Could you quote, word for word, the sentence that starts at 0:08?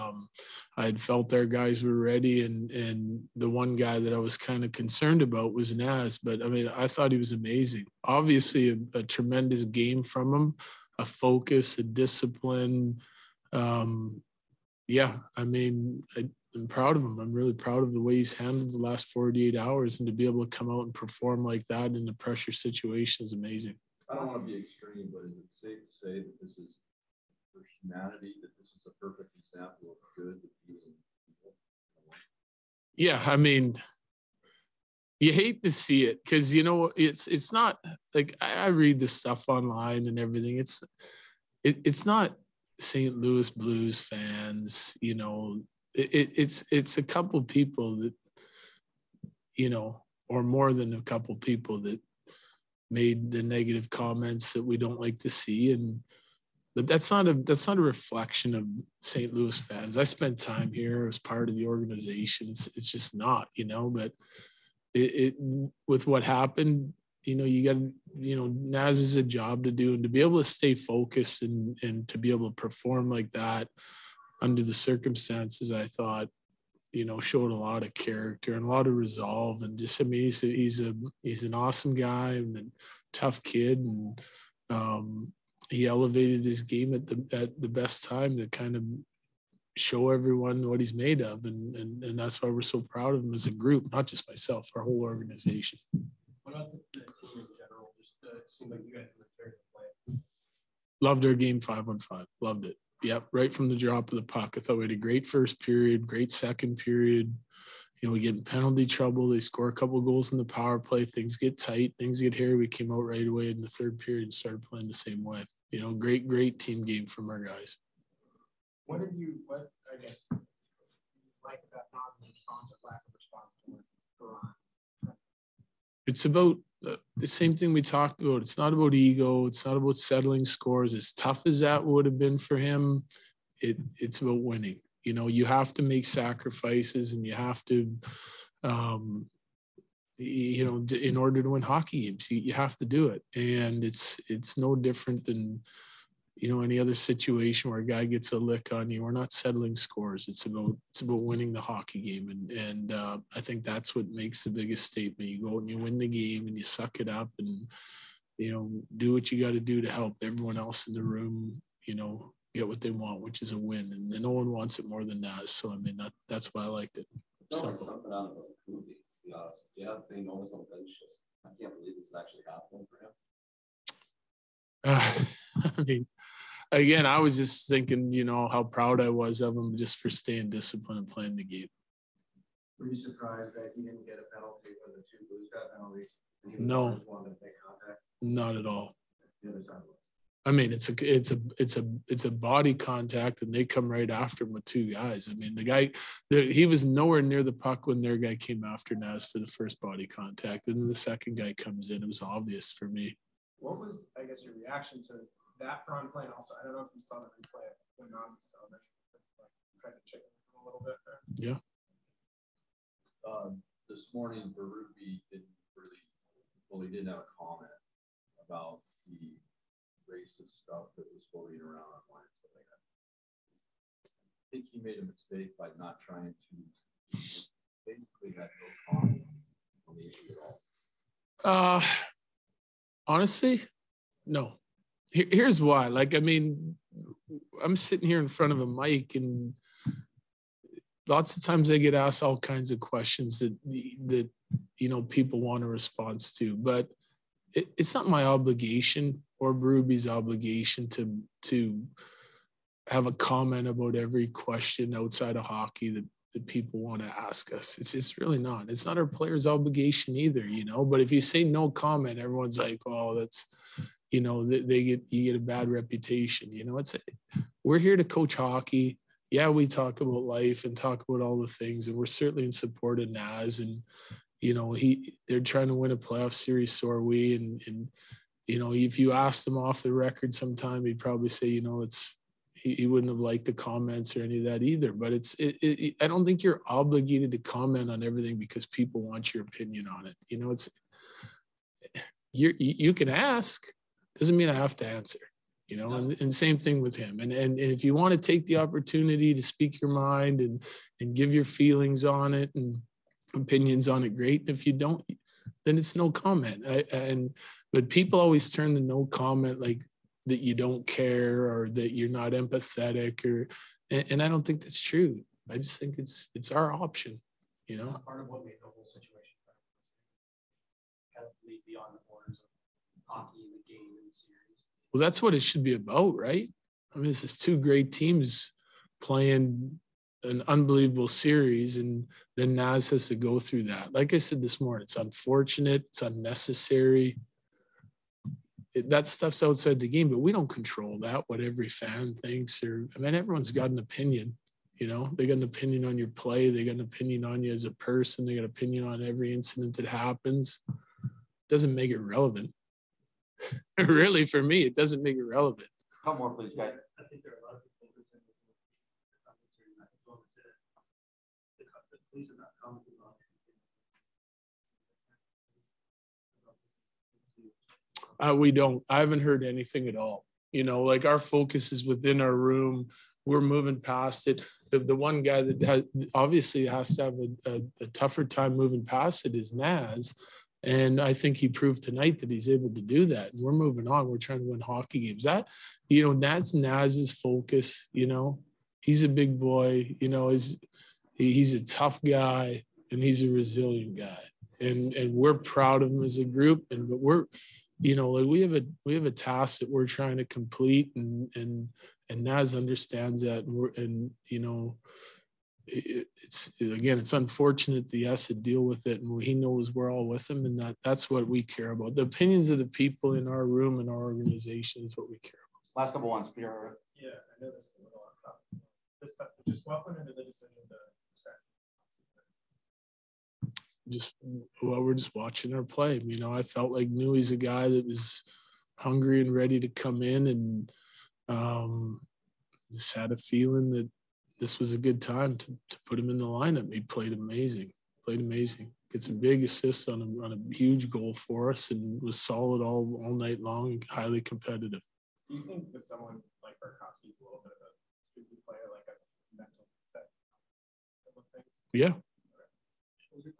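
Obviously, a, a tremendous game from him, a focus, a discipline.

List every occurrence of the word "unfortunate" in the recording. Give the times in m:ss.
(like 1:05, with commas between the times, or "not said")
5:34, 6:47.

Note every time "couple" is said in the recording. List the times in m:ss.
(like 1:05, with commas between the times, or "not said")
0:47, 0:51, 1:49, 6:55.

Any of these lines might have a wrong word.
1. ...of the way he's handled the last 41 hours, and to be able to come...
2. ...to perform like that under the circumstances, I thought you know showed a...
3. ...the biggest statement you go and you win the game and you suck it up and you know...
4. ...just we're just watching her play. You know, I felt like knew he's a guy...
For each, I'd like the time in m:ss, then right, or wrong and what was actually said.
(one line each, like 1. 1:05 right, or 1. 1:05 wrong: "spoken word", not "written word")
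1. 0:17 wrong: "48", not "41"
2. 1:12 right
3. 2:34 right
4. 7:03 right.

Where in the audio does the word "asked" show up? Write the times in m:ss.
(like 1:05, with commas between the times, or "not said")
4:01, 4:39.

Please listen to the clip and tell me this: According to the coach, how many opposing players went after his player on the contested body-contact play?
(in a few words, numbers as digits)
2.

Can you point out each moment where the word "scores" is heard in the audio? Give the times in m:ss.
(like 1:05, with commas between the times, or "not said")
1:49, 2:10, 2:29.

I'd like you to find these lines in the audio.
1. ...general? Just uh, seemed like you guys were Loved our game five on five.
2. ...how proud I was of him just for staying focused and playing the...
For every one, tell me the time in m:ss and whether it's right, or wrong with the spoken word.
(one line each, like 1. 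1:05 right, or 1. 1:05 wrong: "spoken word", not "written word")
1. 1:37 right
2. 2:58 wrong: "disciplined", not "focused".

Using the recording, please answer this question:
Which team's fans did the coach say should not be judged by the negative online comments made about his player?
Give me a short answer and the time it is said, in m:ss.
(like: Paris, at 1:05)
St. Louis Blues, at 0:42.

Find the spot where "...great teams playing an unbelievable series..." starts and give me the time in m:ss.
5:27.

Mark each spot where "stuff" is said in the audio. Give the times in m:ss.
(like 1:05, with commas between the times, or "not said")
0:39, 3:40, 5:39, 6:59.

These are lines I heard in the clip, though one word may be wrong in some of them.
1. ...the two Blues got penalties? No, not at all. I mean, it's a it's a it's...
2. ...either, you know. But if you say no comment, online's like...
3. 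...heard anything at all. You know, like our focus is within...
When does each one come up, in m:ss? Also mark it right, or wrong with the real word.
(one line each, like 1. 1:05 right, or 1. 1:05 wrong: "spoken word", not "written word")
1. 3:04 right
2. 4:20 wrong: "everyone", not "online"
3. 6:09 right.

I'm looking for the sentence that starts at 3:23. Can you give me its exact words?
What was, I guess, your reaction to that Braun play?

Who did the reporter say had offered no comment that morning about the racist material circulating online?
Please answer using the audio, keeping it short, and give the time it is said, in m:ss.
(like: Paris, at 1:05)
Berube, at 3:34.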